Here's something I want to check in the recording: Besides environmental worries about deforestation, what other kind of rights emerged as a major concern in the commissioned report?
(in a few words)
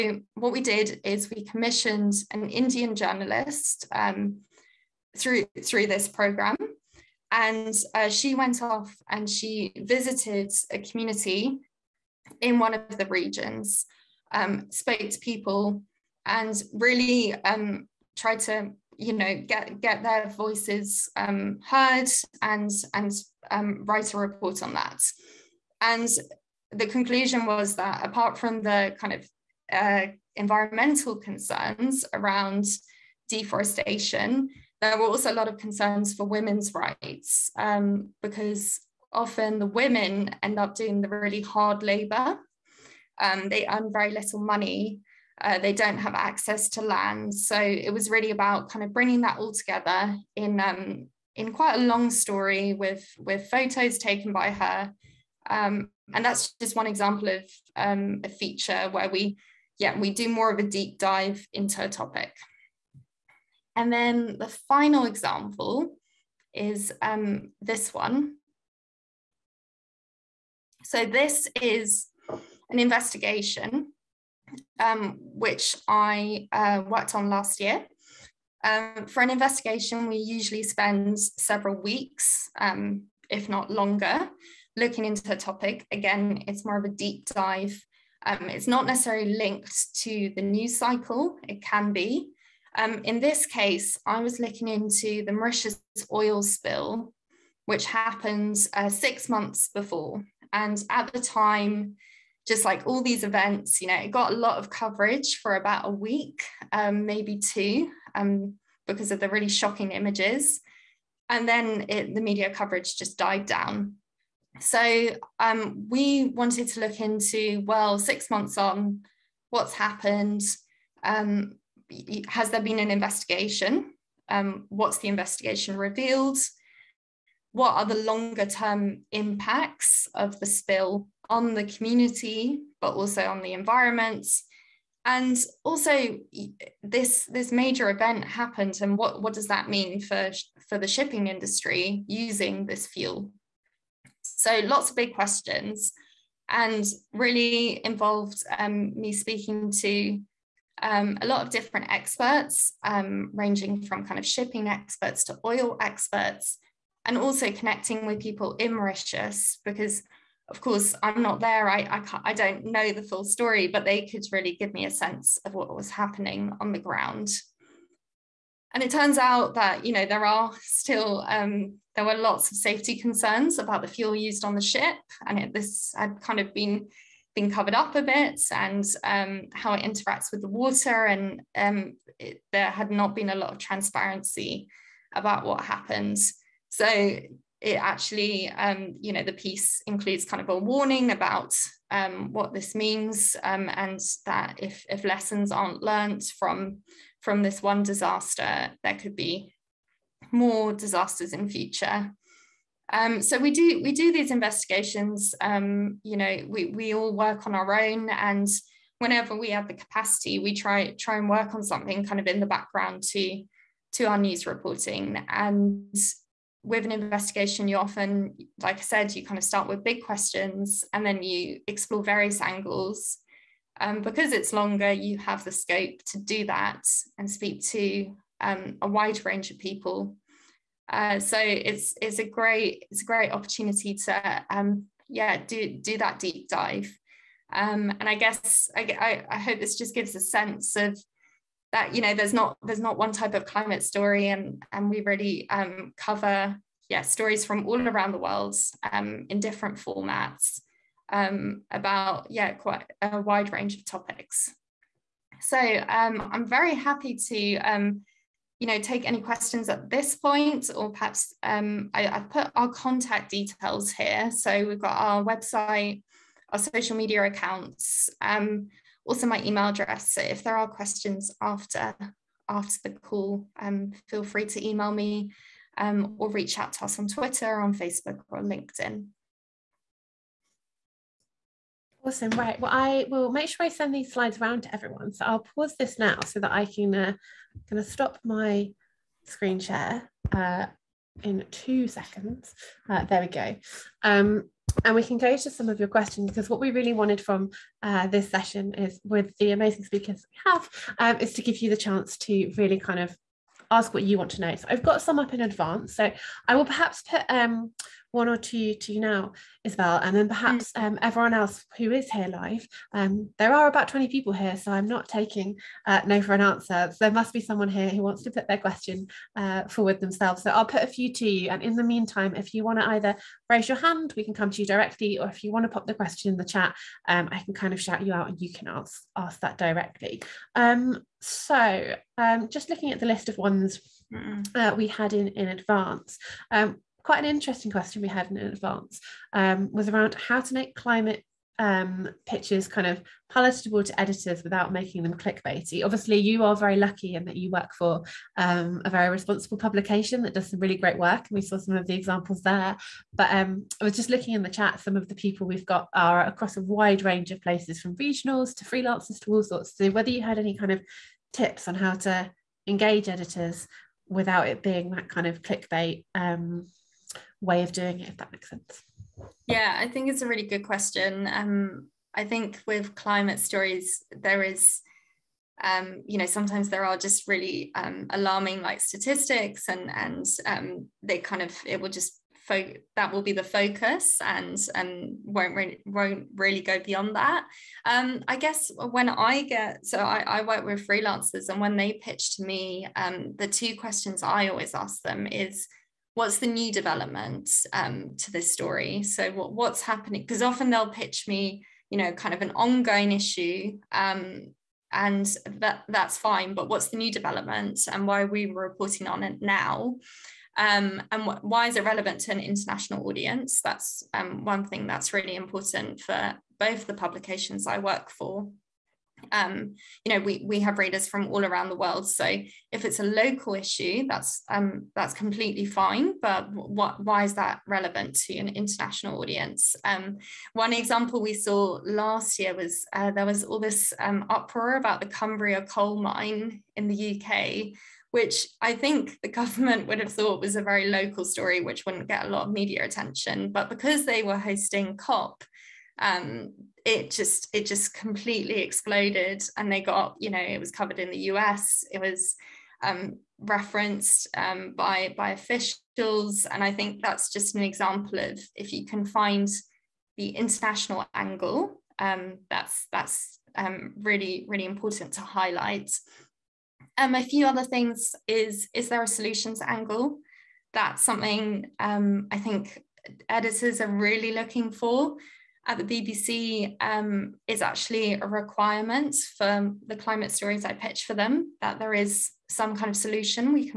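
women's rights.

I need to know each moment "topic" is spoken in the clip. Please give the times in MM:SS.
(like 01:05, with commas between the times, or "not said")
01:01, 01:25, 04:13.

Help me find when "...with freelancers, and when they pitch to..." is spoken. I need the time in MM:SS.
06:30.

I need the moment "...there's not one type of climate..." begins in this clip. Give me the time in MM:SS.
04:02.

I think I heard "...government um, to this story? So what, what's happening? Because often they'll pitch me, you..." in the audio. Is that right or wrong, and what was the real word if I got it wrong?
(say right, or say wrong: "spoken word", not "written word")
wrong: "development", not "government".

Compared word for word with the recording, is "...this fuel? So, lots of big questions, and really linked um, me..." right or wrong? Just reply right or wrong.
wrong.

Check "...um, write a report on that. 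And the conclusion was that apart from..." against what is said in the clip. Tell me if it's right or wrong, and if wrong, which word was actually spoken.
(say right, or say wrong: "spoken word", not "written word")
right.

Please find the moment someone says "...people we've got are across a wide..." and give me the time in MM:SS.
05:55.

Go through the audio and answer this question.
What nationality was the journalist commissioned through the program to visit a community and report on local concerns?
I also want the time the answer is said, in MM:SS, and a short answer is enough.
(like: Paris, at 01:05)
Indian, at 00:02.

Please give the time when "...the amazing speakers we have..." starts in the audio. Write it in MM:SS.
04:59.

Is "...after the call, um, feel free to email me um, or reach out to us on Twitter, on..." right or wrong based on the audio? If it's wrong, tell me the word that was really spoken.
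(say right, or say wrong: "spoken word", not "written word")
right.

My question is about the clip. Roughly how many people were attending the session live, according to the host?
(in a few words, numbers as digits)
20.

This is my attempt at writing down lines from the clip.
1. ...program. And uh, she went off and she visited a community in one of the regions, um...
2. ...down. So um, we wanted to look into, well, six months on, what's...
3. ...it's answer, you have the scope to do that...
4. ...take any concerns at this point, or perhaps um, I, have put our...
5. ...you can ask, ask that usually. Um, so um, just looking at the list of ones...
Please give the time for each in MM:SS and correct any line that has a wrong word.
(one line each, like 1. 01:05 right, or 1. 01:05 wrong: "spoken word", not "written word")
1. 00:06 right
2. 01:53 right
3. 03:44 wrong: "longer", not "answer"
4. 04:18 wrong: "questions", not "concerns"
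5. 05:28 wrong: "directly", not "usually".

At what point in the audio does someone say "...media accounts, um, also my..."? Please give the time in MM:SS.
04:26.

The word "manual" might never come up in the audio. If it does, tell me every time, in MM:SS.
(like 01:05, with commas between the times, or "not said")
not said.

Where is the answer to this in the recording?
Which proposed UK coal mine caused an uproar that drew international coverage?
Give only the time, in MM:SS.
07:15.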